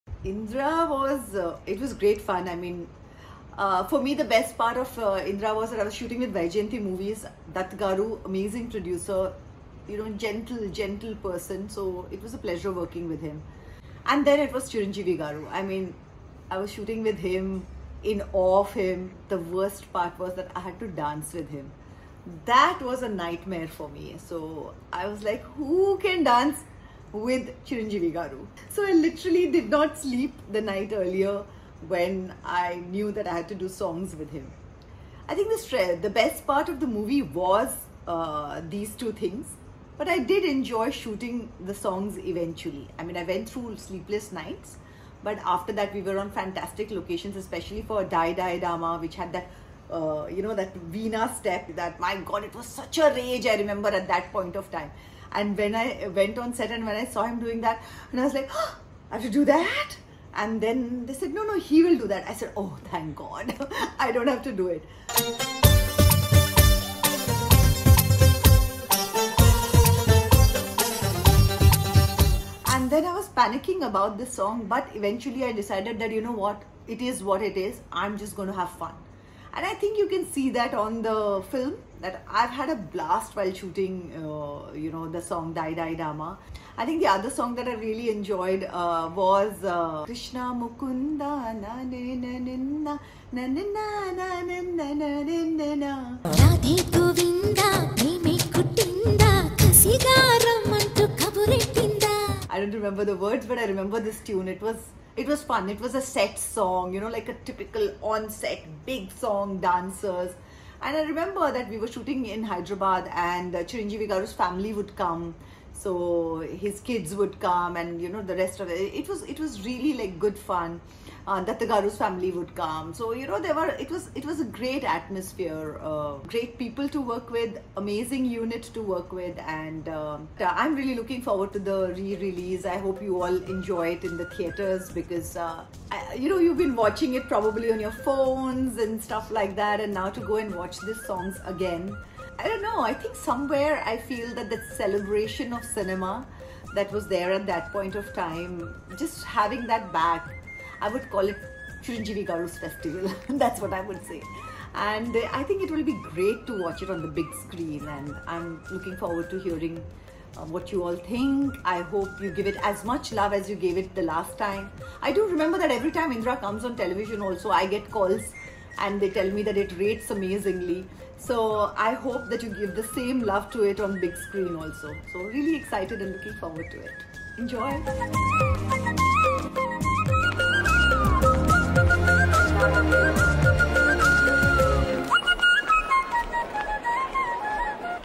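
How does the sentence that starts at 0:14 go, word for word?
And then it was Chiranjeevi Garu.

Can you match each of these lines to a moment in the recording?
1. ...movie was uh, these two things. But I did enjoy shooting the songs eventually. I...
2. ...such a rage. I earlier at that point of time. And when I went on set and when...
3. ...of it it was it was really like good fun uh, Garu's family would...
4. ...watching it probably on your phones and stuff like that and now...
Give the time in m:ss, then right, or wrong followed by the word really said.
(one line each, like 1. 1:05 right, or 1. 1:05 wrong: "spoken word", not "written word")
1. 0:36 right
2. 0:52 wrong: "remember", not "earlier"
3. 1:58 right
4. 2:16 right.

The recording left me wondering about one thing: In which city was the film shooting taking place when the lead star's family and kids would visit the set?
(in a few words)
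Hyderabad.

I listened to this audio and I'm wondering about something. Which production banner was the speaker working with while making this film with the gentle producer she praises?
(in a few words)
Vaijayanti Movies.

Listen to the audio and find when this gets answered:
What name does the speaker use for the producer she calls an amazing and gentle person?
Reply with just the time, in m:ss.
0:07.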